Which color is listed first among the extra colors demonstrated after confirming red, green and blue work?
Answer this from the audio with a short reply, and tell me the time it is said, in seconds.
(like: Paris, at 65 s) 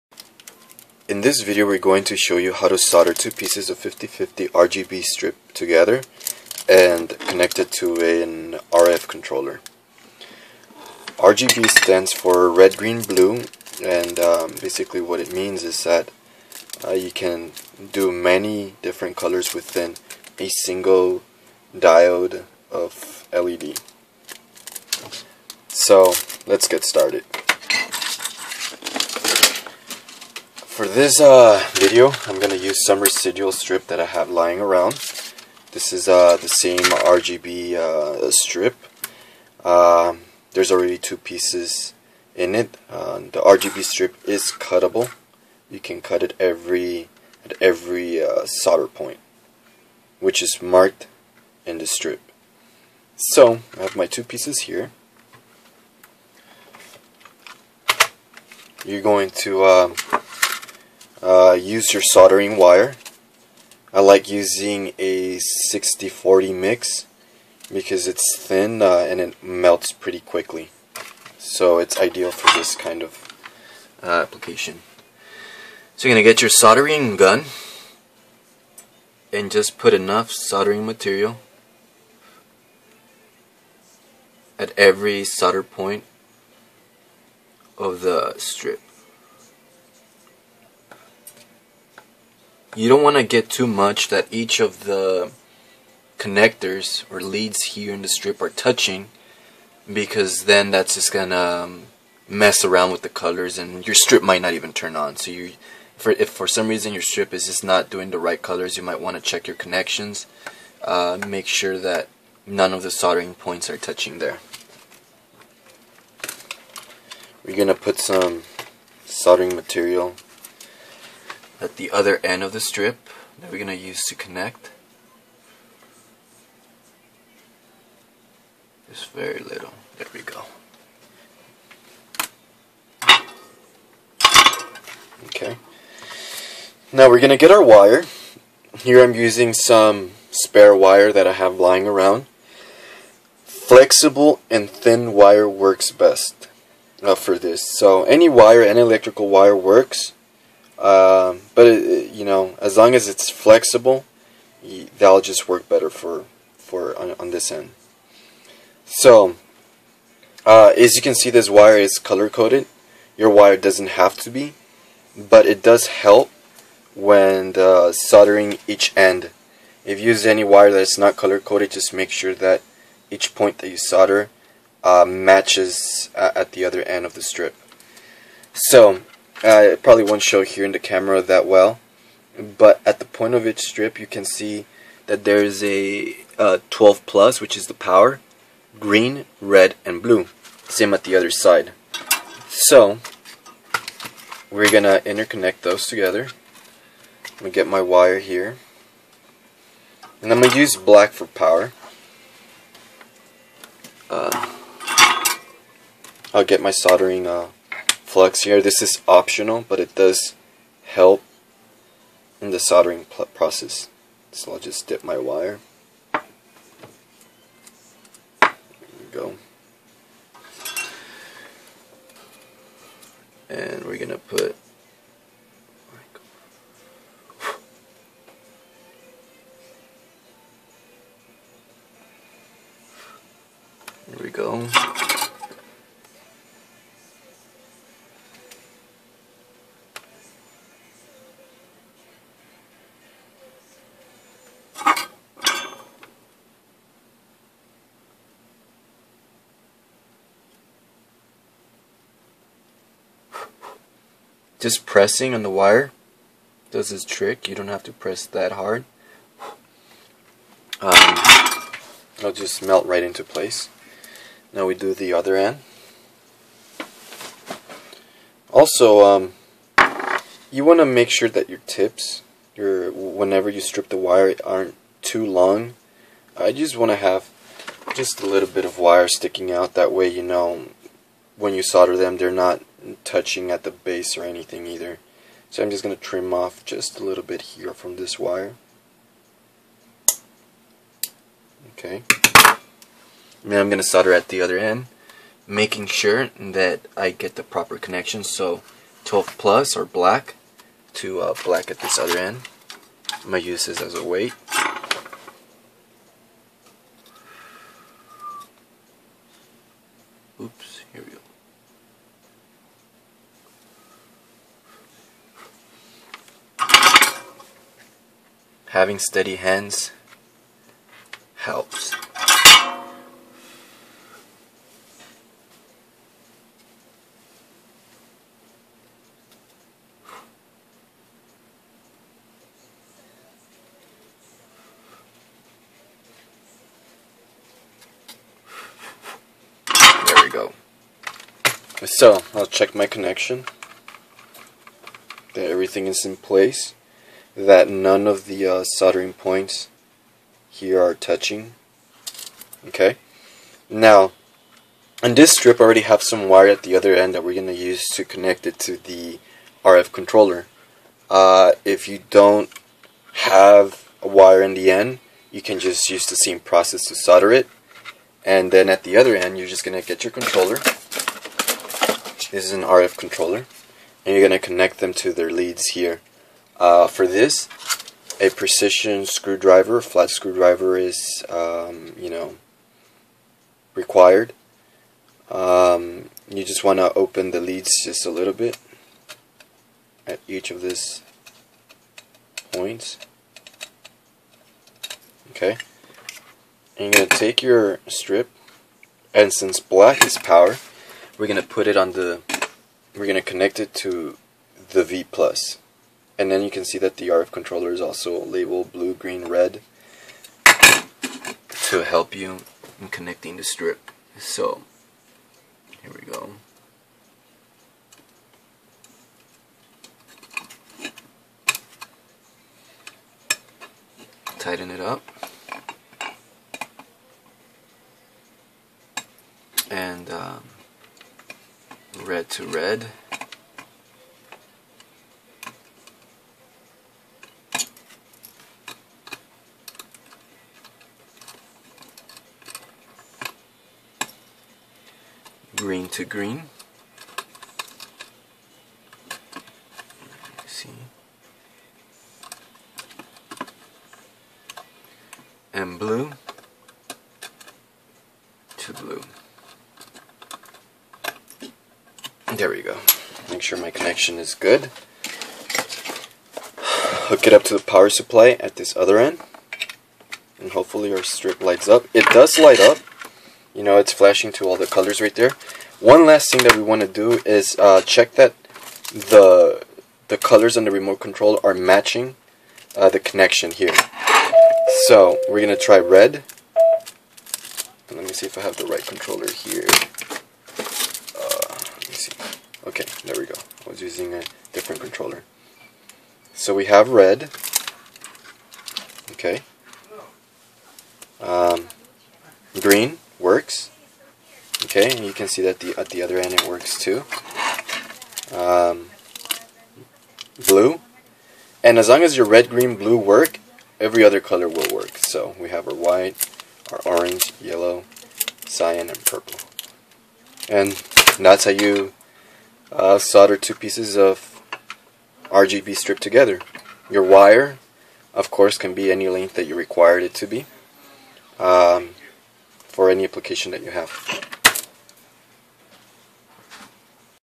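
White, at 515 s.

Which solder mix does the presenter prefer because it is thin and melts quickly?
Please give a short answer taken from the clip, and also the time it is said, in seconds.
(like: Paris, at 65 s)
60-40, at 65 s.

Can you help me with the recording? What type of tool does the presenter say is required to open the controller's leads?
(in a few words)
Precision screwdriver.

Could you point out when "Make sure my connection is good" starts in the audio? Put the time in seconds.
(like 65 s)
463 s.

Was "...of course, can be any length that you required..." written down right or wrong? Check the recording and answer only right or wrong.
right.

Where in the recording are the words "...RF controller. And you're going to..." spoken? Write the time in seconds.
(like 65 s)
372 s.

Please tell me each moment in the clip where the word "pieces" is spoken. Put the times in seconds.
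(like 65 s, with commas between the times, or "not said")
3 s, 41 s, 54 s, 523 s.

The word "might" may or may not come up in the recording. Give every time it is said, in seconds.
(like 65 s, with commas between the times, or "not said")
104 s, 108 s.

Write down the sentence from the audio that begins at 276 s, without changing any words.
I just want to have just a little bit of wire sticking out.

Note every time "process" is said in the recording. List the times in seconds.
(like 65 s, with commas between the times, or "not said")
213 s, 366 s.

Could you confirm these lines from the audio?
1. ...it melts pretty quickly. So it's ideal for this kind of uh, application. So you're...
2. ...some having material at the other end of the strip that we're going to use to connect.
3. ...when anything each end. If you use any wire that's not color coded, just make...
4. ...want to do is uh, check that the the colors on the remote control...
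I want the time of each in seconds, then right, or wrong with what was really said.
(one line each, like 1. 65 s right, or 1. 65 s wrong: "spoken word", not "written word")
1. 69 s right
2. 117 s wrong: "soldering", not "having"
3. 166 s wrong: "soldering", not "anything"
4. 476 s right.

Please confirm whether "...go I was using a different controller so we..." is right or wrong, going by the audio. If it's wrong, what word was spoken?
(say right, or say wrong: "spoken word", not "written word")
right.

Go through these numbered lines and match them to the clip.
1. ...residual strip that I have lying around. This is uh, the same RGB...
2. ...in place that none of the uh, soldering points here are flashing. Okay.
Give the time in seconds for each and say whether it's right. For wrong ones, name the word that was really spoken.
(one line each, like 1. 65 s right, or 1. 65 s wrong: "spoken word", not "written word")
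1. 33 s right
2. 346 s wrong: "touching", not "flashing".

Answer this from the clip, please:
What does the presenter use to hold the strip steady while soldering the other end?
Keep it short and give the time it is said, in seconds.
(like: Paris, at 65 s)
As a weight, at 303 s.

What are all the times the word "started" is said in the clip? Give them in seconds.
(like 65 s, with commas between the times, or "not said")
26 s.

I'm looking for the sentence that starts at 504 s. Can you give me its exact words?
Okay, and you can see that the at the other end it works too.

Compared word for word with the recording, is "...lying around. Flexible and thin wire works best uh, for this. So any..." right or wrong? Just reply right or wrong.
right.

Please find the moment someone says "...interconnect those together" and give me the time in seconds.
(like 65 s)
195 s.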